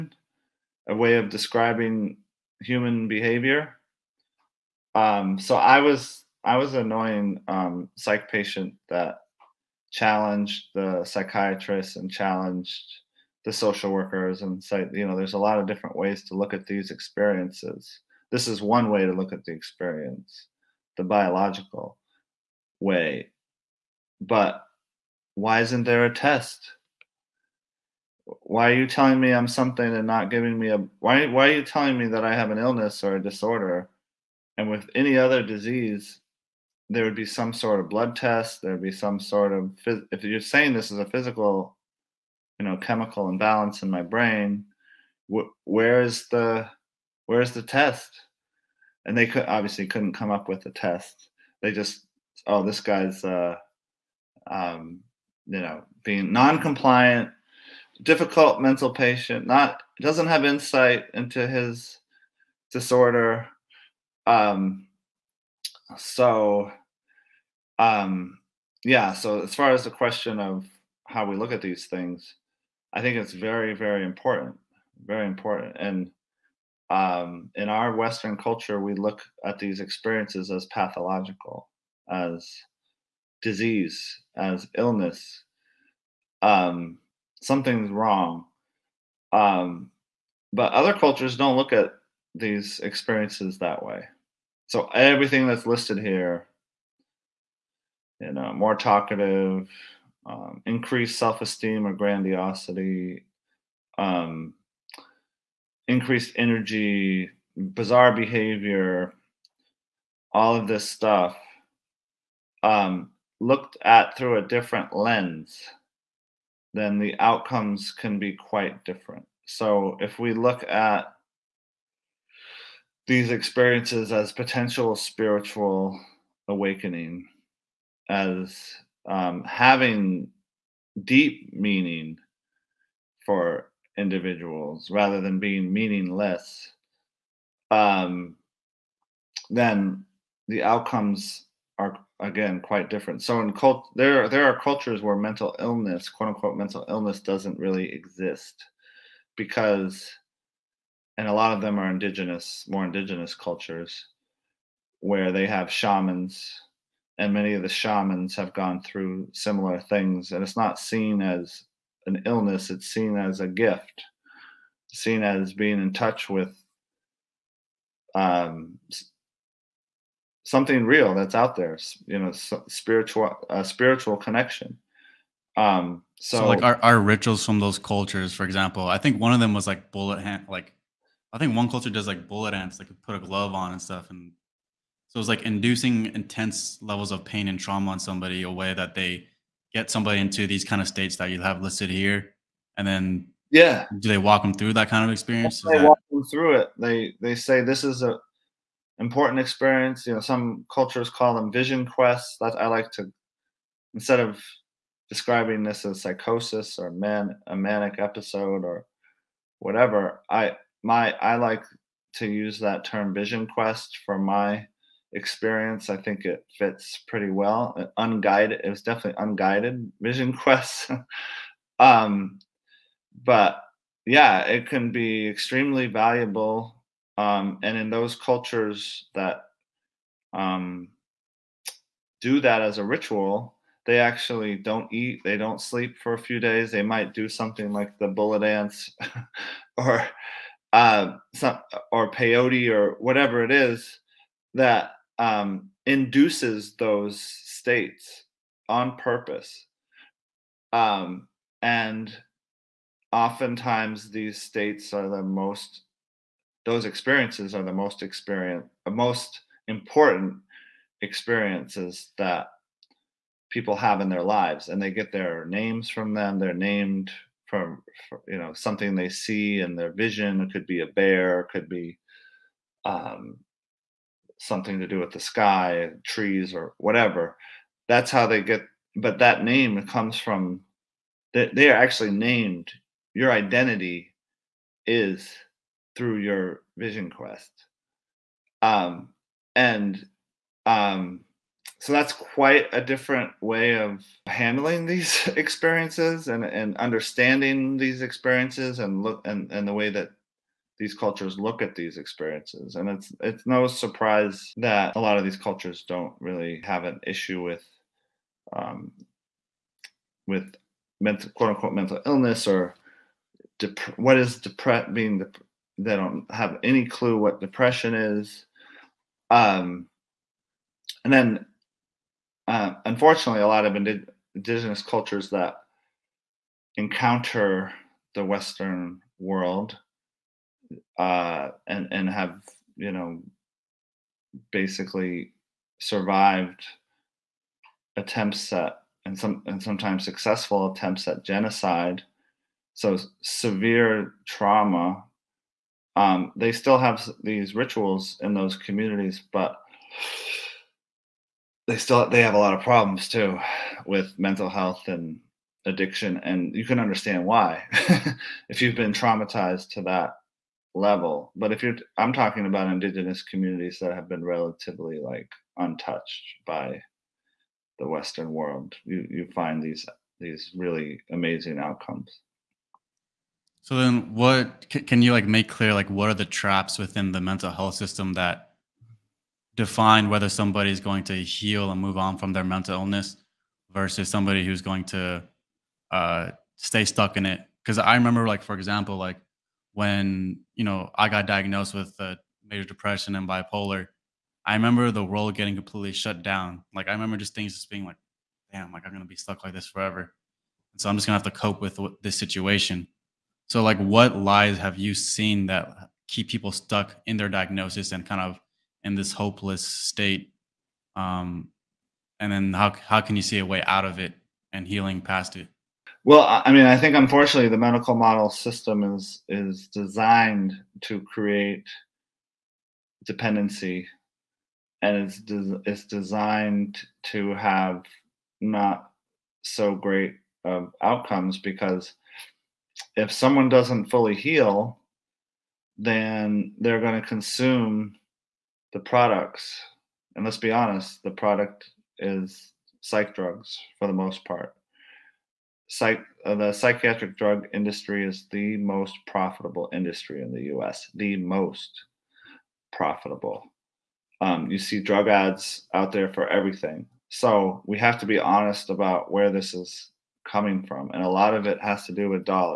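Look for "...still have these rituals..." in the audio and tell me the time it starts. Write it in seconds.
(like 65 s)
346 s.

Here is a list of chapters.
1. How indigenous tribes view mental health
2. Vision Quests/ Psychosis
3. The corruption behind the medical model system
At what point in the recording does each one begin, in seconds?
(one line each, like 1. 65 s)
1. 89 s
2. 175 s
3. 374 s.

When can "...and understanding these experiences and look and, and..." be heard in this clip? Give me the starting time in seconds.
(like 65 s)
296 s.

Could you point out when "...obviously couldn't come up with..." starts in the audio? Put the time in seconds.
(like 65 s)
49 s.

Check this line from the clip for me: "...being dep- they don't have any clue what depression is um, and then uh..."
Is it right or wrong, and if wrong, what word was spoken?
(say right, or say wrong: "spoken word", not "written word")
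right.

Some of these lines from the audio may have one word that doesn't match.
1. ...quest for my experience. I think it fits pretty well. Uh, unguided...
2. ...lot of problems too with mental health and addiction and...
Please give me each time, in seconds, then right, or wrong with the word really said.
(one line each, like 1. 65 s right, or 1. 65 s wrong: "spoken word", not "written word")
1. 213 s right
2. 352 s right.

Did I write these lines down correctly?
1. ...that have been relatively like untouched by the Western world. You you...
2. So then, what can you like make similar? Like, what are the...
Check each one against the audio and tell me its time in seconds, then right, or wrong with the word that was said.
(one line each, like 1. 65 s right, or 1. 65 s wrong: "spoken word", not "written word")
1. 363 s right
2. 373 s wrong: "clear", not "similar".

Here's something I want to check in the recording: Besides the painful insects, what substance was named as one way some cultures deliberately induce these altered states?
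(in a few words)
peyote.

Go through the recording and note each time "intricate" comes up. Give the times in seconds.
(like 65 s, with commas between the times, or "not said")
not said.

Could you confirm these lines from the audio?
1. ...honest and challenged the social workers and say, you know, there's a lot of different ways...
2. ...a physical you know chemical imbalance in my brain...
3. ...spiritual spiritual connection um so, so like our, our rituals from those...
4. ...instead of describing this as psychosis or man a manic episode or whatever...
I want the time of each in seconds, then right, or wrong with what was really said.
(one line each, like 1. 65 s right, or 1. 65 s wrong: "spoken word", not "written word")
1. 11 s wrong: "psychiatrist", not "honest"
2. 41 s right
3. 172 s right
4. 203 s right.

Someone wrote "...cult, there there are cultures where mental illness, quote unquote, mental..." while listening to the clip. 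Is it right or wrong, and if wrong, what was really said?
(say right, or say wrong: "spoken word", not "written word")
right.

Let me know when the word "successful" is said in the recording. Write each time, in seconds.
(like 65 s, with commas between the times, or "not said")
340 s.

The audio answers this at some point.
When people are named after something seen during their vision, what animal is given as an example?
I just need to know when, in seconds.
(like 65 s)
270 s.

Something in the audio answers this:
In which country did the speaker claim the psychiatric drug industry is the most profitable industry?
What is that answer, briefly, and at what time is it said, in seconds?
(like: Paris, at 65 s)
U.S., at 450 s.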